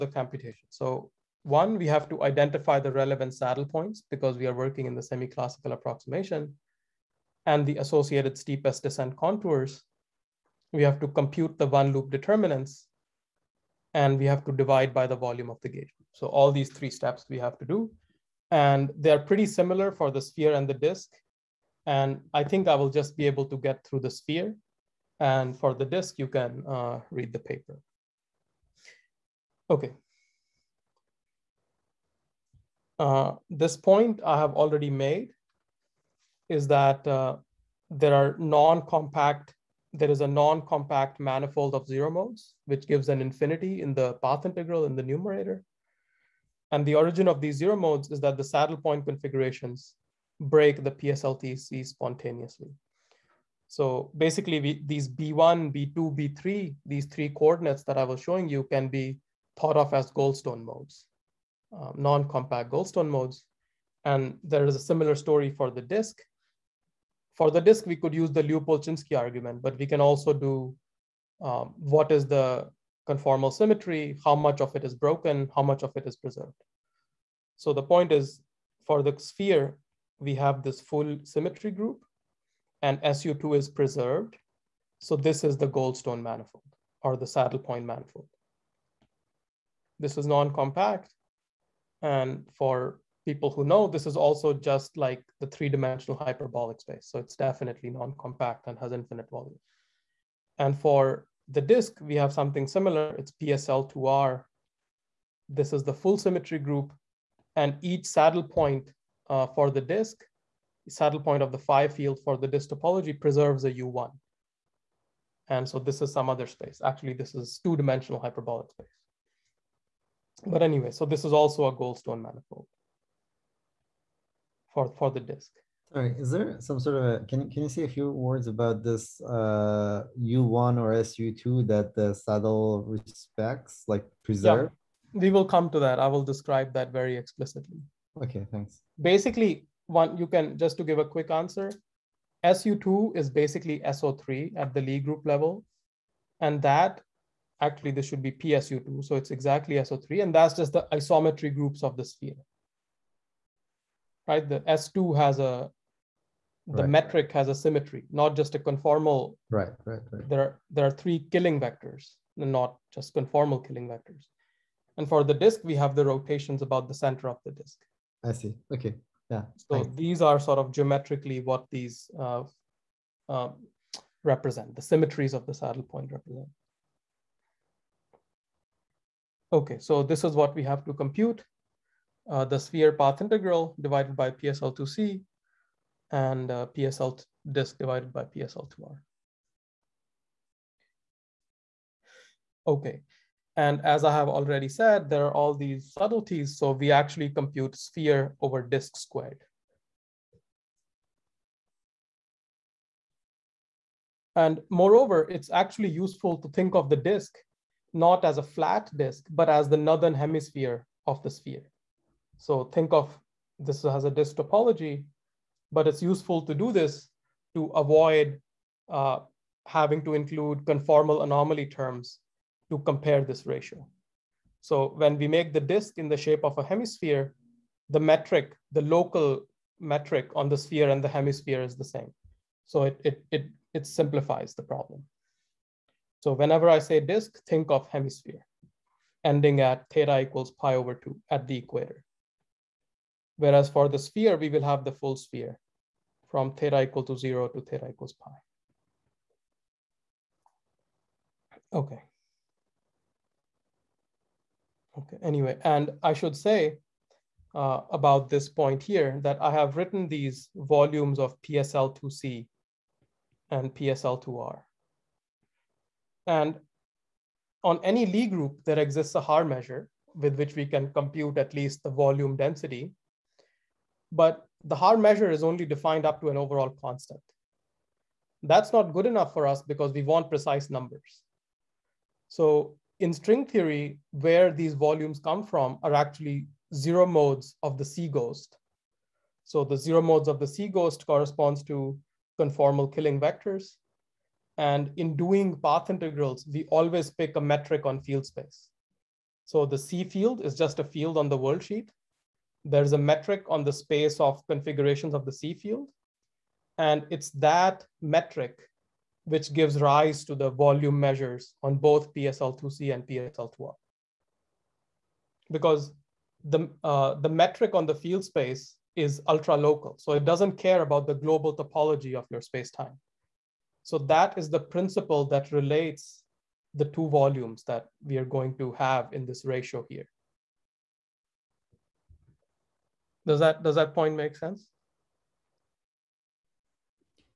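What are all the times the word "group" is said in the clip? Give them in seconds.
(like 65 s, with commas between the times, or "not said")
81 s, 106 s, 144 s, 151 s, 268 s.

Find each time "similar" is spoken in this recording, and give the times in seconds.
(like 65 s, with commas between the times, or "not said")
19 s, 64 s, 102 s.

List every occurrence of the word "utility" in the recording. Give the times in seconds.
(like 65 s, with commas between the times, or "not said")
not said.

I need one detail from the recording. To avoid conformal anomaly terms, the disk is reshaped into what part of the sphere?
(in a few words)
the northern hemisphere.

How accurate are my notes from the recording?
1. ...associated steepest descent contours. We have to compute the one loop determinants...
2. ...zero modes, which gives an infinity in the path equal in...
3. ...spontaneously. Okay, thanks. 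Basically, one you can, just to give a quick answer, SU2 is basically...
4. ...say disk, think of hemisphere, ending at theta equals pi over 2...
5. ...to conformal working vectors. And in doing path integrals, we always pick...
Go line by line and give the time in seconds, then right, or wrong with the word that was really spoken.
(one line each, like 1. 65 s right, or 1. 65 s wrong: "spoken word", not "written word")
1. 7 s right
2. 41 s wrong: "integral", not "equal"
3. 137 s wrong: "explicitly", not "spontaneously"
4. 236 s right
5. 291 s wrong: "killing", not "working".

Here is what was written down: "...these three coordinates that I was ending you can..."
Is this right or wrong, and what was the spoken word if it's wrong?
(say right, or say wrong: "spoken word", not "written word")
wrong: "showing", not "ending".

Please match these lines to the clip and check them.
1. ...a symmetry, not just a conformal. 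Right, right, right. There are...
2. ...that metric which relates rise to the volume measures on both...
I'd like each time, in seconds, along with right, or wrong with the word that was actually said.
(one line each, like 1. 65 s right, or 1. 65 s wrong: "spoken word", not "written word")
1. 157 s right
2. 307 s wrong: "gives", not "relates".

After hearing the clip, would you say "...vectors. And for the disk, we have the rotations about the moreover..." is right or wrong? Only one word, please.
wrong.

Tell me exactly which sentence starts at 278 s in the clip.
That's not good enough for us because we want precise numbers.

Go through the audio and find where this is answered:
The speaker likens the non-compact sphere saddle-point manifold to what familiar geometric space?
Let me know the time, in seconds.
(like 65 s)
95 s.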